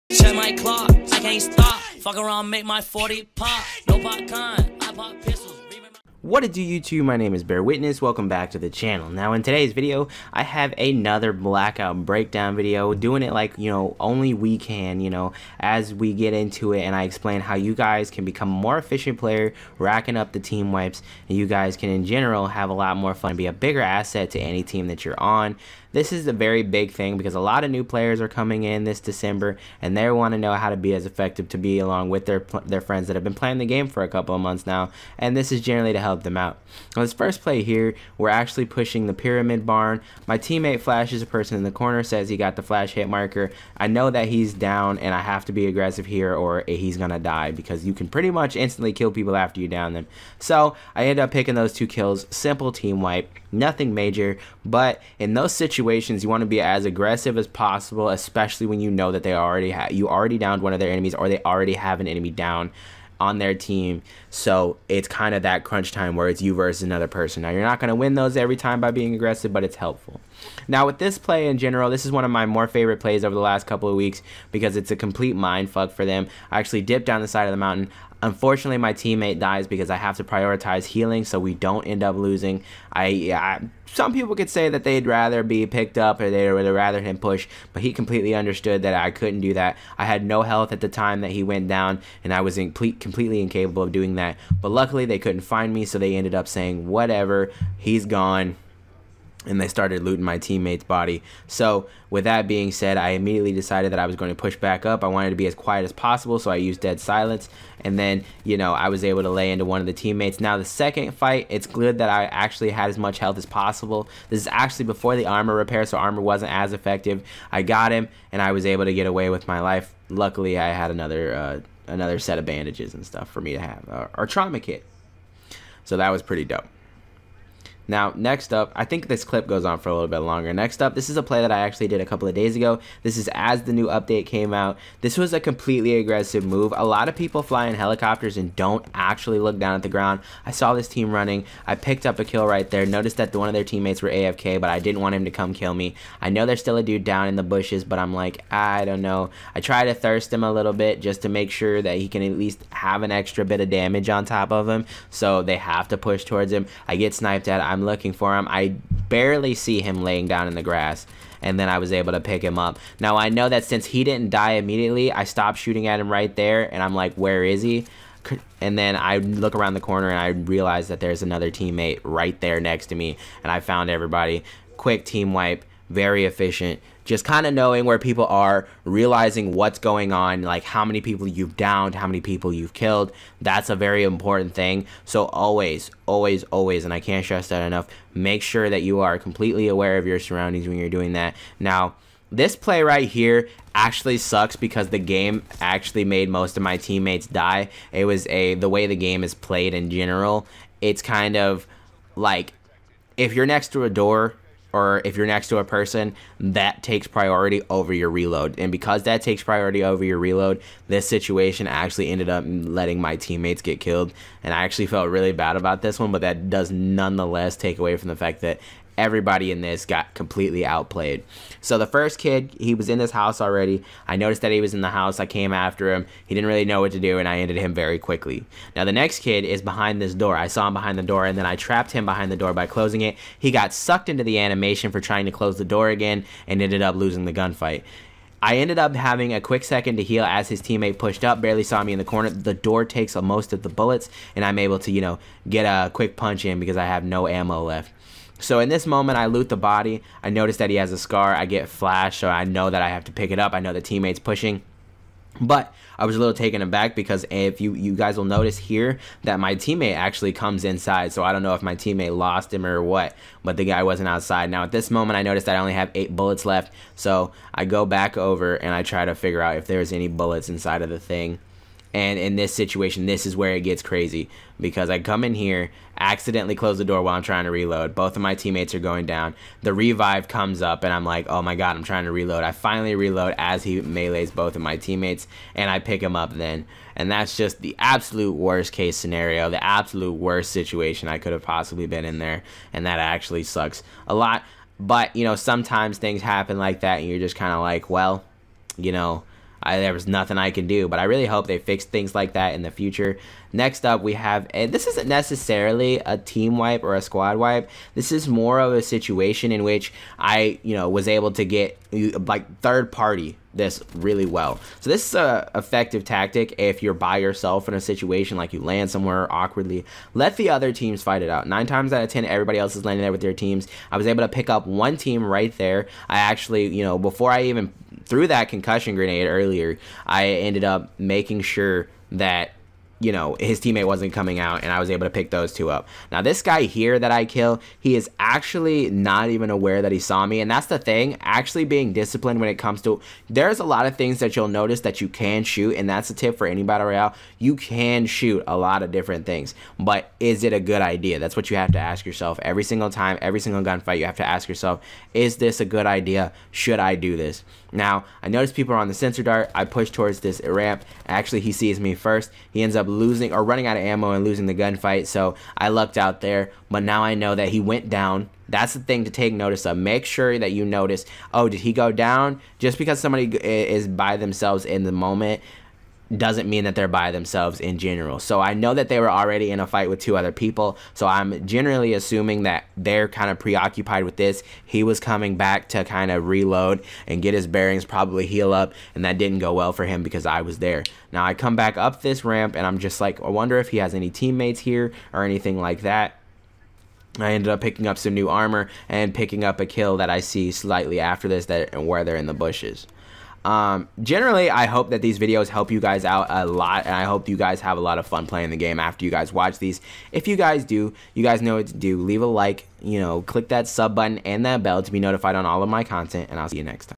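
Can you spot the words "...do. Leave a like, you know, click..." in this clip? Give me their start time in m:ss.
6:51.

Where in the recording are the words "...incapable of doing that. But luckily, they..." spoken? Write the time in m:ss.
1:33.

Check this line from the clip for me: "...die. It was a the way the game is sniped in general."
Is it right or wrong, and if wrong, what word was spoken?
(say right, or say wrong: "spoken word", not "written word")
wrong: "played", not "sniped".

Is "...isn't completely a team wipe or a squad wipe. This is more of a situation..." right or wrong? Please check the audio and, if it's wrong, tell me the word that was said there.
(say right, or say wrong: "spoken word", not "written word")
wrong: "necessarily", not "completely".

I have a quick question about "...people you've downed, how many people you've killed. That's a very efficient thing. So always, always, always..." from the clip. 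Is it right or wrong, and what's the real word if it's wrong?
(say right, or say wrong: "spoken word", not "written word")
wrong: "important", not "efficient".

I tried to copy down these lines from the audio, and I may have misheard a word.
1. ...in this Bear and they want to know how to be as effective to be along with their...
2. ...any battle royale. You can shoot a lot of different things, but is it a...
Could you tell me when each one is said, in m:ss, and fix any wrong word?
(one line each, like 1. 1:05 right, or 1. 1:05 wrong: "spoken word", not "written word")
1. 0:28 wrong: "December", not "Bear"
2. 5:46 right.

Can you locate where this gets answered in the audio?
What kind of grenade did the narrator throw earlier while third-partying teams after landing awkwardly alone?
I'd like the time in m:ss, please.
5:28.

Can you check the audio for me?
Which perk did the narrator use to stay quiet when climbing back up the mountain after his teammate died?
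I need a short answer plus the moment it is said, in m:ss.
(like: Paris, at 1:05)
dead silence, at 1:46.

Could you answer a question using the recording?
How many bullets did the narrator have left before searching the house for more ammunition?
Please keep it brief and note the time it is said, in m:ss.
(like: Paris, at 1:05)
8, at 4:25.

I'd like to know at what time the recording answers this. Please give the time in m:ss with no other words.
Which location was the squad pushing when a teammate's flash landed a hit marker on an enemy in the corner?
0:39.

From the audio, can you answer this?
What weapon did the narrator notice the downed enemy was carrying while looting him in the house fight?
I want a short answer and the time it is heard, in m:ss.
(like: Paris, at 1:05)
scar, at 4:10.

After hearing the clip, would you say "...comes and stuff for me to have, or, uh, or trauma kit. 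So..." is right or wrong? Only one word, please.
wrong.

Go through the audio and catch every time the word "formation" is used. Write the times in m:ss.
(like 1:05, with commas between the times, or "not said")
not said.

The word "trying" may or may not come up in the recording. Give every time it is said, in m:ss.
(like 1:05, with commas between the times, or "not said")
3:55, 4:37, 4:41.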